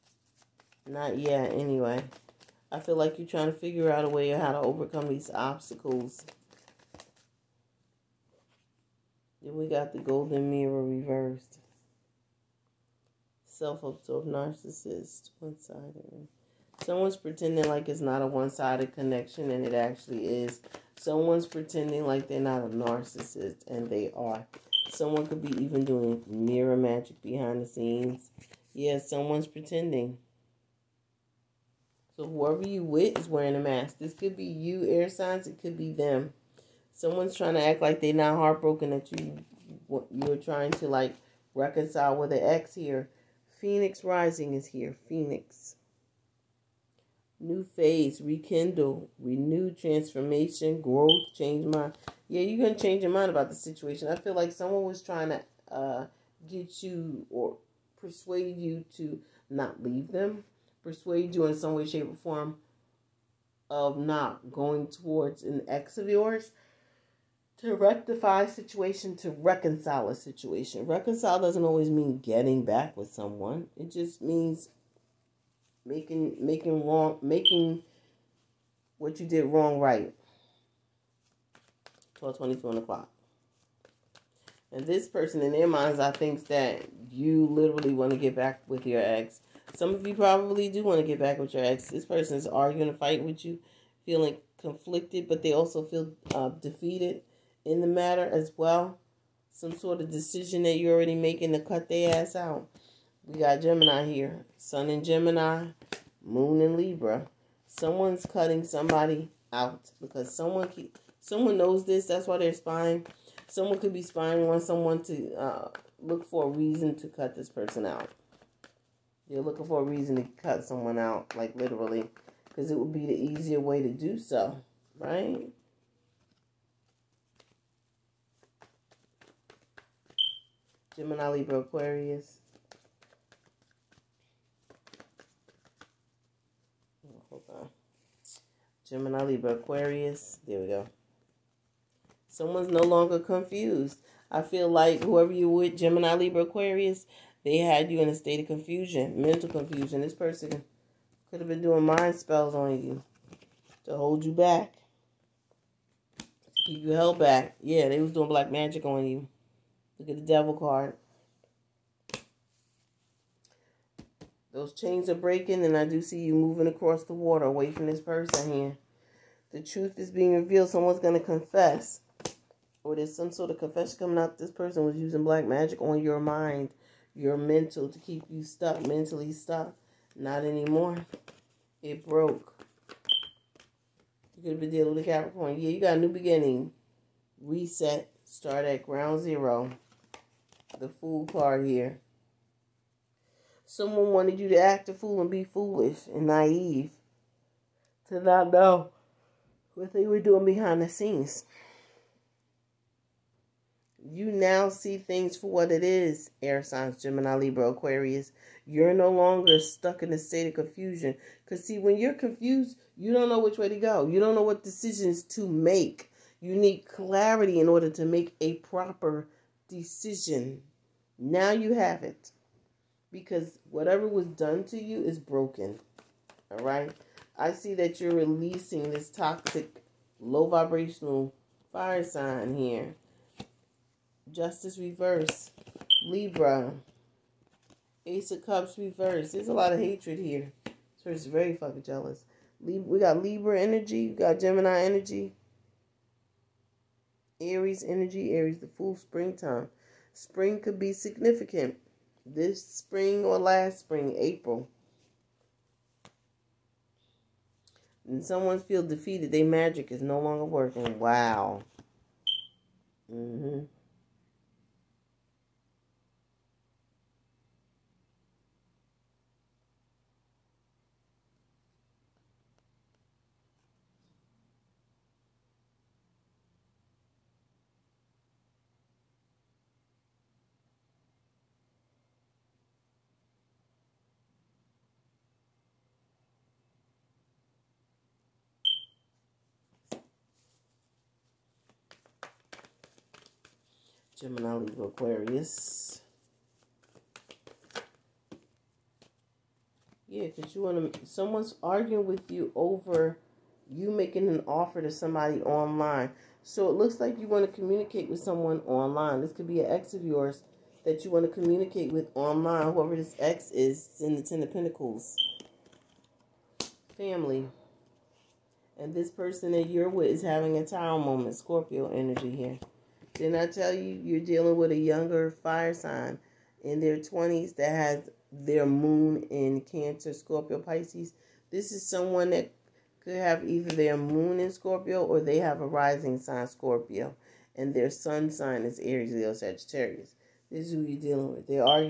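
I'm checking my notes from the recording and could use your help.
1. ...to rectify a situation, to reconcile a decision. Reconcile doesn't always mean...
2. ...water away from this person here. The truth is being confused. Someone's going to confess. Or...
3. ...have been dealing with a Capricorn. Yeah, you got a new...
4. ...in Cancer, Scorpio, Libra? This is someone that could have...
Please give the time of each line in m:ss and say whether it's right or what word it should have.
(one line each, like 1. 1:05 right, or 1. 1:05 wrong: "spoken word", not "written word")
1. 1:07 wrong: "situation", not "decision"
2. 2:47 wrong: "revealed", not "confused"
3. 3:04 right
4. 5:29 wrong: "Pisces", not "Libra".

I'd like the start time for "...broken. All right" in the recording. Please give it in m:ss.
3:45.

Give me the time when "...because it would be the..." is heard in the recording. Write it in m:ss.
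2:02.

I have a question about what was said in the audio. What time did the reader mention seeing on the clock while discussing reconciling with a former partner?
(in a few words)
12:22.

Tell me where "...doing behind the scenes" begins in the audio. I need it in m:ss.
3:20.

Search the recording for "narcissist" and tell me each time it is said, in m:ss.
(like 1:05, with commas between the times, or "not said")
0:14, 0:22.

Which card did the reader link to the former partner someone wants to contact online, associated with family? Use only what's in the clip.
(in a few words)
Ten of Pentacles.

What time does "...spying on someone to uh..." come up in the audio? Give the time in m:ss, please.
1:54.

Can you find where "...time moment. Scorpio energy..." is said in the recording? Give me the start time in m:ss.
5:20.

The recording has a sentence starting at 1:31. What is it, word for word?
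This person is arguing a fight with you, feeling conflicted, but they also feel uh, defeated in the matter as well.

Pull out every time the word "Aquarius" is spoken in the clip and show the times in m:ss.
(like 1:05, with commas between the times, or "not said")
2:11, 2:19, 2:26, 3:27, 4:54.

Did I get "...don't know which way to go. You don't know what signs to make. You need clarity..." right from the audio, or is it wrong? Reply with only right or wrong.
wrong.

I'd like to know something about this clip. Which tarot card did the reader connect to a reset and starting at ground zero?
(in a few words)
The Fool.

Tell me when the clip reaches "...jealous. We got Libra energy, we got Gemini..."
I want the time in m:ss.
4:01.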